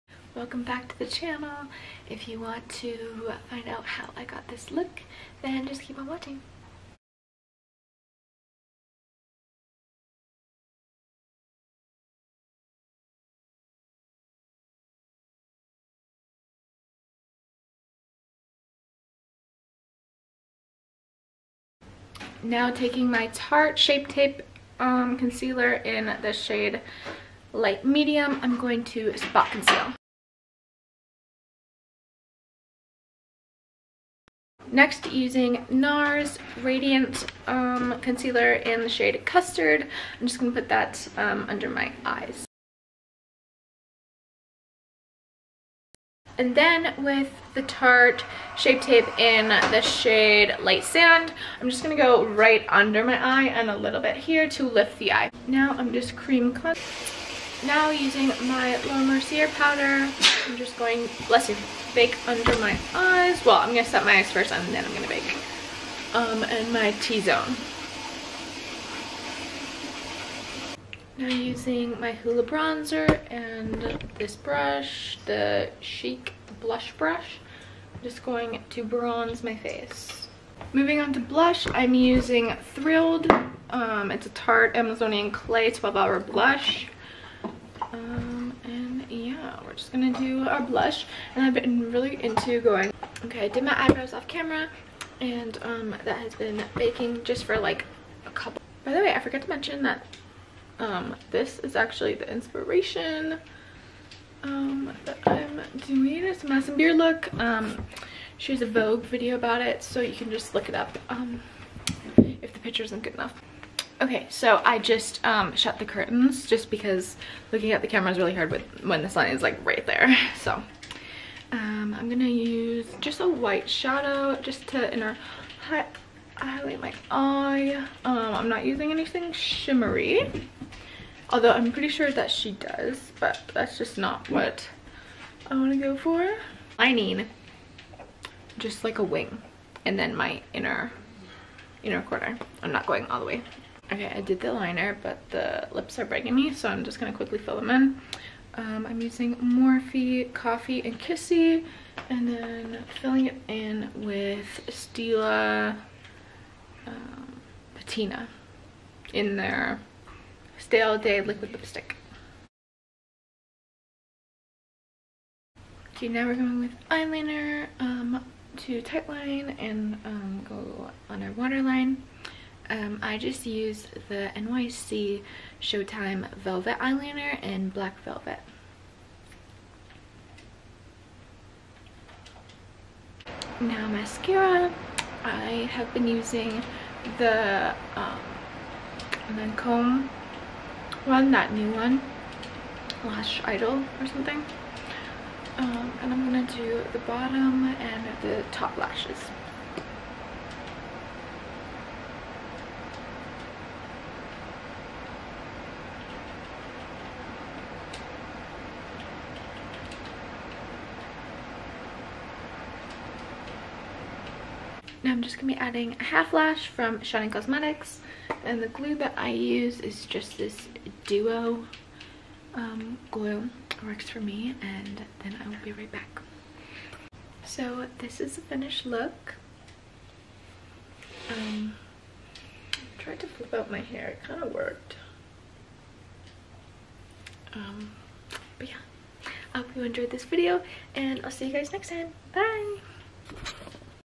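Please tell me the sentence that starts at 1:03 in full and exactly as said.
Well, I'm going to set my eyes first and then I'm going to bake.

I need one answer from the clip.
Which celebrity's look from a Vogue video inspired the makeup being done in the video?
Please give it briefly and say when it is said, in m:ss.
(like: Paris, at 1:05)
Madison Beer, at 1:46.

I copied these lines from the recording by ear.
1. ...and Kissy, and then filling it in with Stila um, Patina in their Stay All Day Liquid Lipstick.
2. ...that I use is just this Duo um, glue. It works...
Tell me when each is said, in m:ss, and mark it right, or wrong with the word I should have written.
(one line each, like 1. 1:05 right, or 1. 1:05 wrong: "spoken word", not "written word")
1. 2:30 right
2. 3:38 right.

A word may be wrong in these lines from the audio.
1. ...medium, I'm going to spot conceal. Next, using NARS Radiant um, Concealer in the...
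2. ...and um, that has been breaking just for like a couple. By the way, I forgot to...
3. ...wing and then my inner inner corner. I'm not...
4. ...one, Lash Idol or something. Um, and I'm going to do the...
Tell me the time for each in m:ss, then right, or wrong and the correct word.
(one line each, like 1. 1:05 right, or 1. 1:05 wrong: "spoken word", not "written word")
1. 0:27 right
2. 1:35 wrong: "baking", not "breaking"
3. 2:19 right
4. 3:11 right.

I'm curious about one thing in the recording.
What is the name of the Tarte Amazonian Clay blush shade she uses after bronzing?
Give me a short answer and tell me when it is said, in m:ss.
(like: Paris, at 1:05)
Thrilled, at 1:22.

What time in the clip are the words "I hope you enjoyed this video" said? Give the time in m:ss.
3:59.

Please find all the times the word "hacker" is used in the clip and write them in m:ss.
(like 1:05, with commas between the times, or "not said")
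not said.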